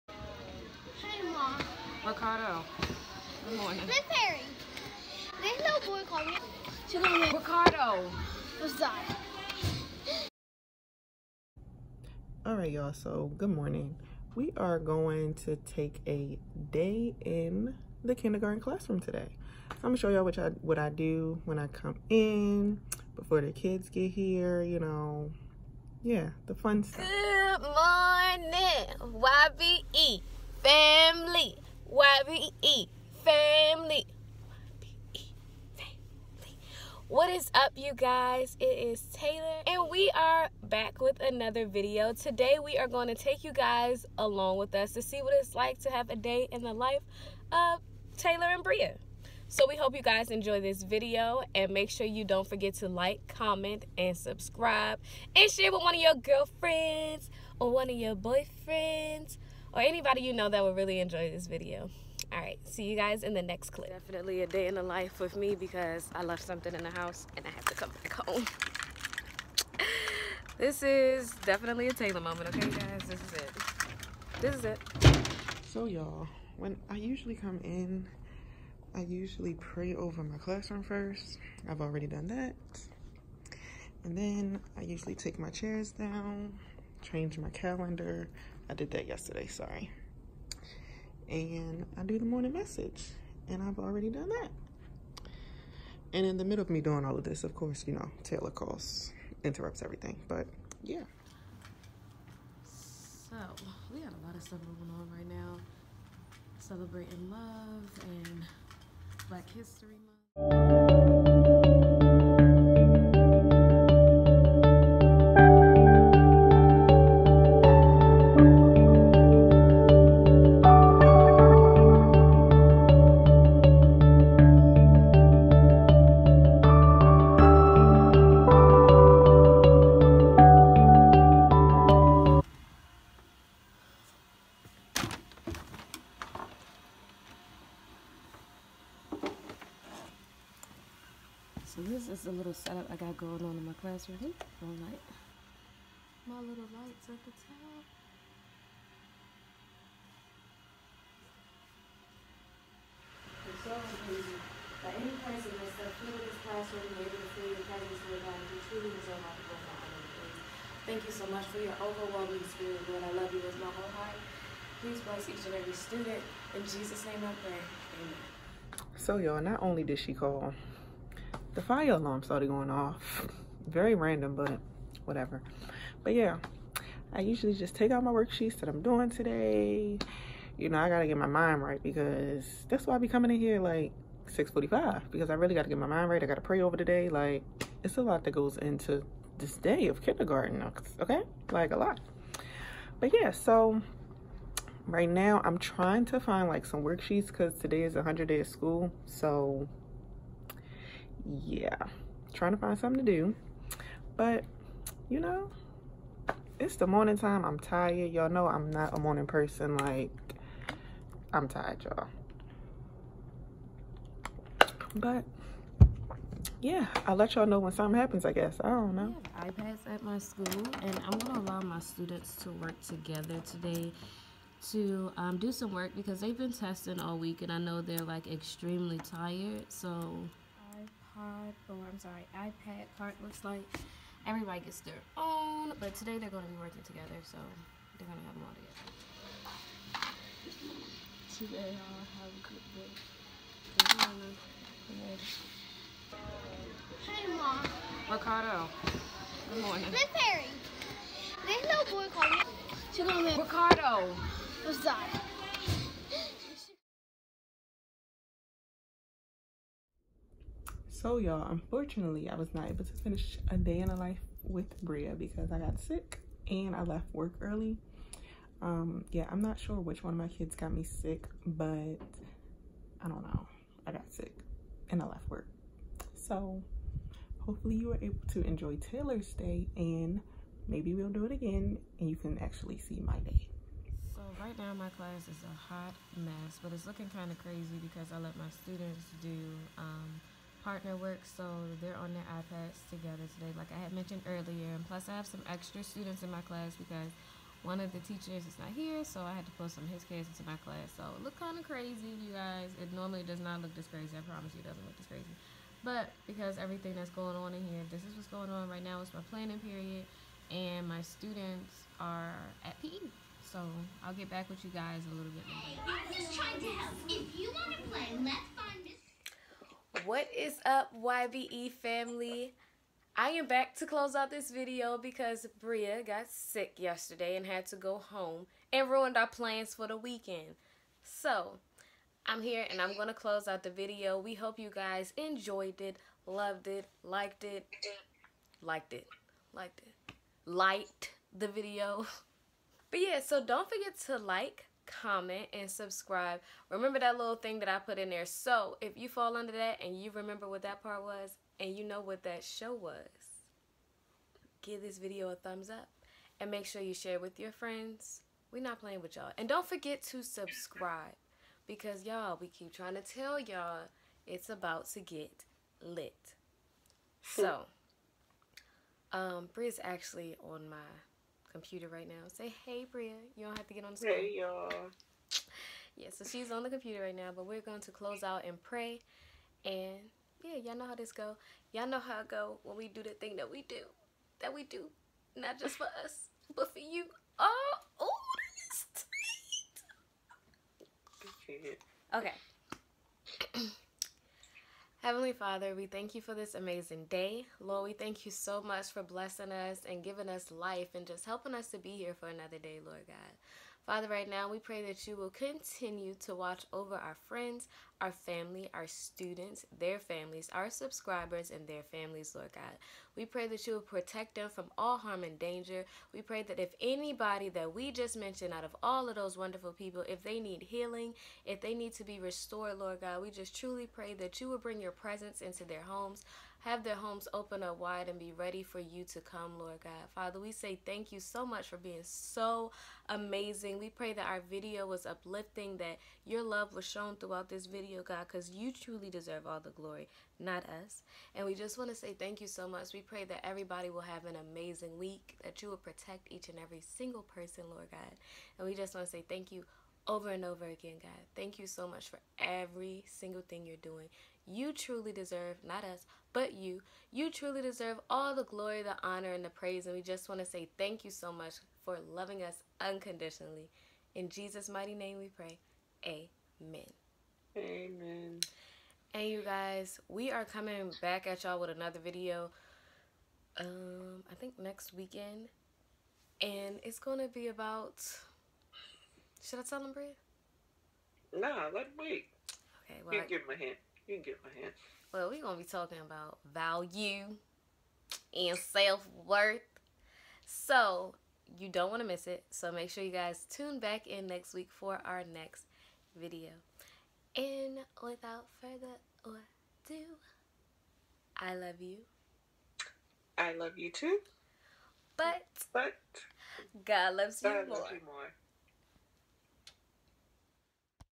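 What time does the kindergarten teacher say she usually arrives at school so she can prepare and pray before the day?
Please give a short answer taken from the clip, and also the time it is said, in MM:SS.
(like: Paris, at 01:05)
6:45, at 03:04.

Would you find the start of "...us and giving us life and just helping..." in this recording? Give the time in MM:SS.
06:39.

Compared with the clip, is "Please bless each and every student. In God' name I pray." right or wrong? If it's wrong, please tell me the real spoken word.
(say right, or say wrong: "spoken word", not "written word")
wrong: "Jesus", not "God".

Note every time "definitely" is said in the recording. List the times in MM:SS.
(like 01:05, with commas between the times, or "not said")
01:03, 01:11.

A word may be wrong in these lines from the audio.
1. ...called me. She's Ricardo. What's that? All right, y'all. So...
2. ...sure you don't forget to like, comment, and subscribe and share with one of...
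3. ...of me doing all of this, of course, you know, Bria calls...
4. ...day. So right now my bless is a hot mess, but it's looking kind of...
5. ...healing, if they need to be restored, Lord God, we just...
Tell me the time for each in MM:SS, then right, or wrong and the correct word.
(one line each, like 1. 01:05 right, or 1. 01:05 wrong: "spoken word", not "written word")
1. 00:06 right
2. 00:51 right
3. 01:36 wrong: "Taylor", not "Bria"
4. 04:43 wrong: "class", not "bless"
5. 07:00 right.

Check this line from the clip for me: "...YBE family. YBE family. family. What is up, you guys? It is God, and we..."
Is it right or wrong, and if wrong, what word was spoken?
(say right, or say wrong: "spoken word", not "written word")
wrong: "Taylor", not "God".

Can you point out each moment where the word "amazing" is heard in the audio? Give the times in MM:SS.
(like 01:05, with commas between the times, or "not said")
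02:33, 06:36, 07:13, 07:24.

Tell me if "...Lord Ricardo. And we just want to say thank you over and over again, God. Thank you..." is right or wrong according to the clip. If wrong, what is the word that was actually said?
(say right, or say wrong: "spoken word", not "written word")
wrong: "God", not "Ricardo".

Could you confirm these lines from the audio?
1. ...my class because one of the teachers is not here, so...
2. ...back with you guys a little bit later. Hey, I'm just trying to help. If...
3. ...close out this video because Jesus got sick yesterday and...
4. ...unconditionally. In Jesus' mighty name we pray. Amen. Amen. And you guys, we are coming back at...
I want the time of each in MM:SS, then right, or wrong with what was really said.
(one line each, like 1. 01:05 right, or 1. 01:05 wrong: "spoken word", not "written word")
1. 04:56 right
2. 05:14 right
3. 05:23 wrong: "Bria", not "Jesus"
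4. 07:42 right.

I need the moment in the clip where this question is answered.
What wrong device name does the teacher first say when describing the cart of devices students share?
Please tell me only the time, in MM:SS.
03:50.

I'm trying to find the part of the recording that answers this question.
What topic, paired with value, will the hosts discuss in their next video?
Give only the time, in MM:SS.
08:08.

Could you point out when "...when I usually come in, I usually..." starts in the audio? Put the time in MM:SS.
01:16.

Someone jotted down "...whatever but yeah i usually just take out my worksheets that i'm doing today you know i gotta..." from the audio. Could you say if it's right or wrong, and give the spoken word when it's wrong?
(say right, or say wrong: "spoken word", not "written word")
right.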